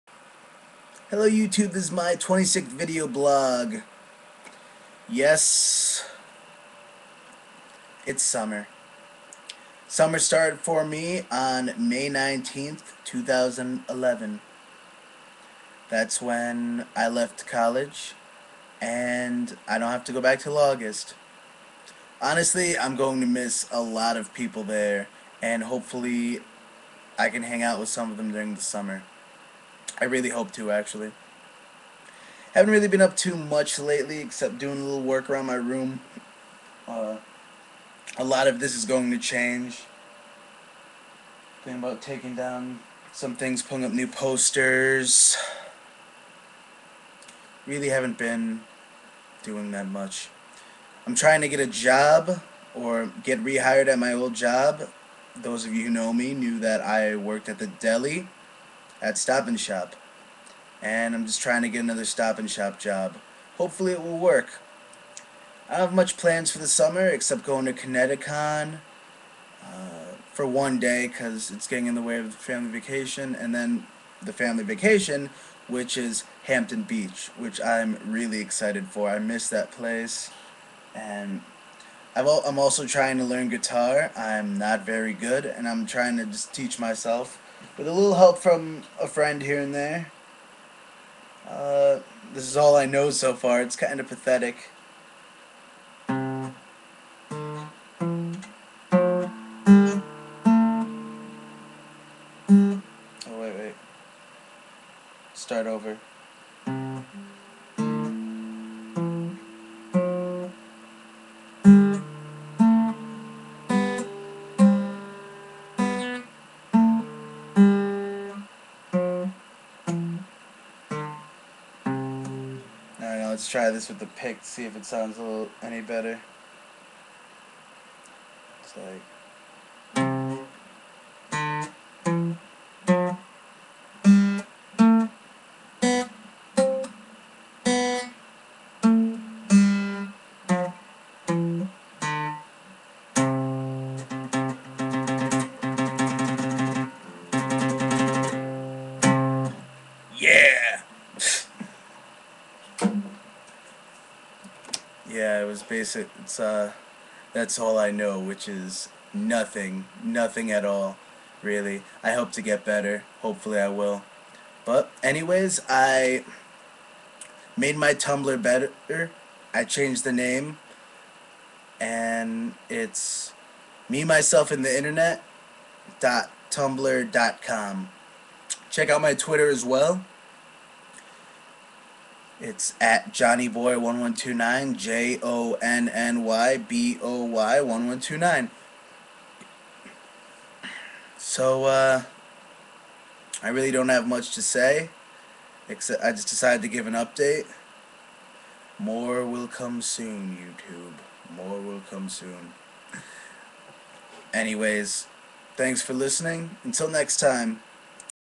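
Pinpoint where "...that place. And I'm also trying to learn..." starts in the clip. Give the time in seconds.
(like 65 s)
79 s.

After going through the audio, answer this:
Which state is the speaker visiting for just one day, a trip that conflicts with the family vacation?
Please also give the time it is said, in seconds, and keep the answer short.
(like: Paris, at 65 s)
Connecticut, at 67 s.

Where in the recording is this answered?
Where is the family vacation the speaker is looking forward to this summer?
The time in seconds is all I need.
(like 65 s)
76 s.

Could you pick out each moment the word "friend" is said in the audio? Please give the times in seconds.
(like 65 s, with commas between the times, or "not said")
89 s.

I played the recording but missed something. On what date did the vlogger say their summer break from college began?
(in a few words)
May 19th, 2011.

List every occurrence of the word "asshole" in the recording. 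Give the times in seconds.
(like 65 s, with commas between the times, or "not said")
not said.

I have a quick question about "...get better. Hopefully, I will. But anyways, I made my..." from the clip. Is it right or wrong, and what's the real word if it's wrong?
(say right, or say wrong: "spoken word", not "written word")
right.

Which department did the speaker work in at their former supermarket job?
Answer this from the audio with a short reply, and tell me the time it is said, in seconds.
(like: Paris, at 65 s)
the deli, at 57 s.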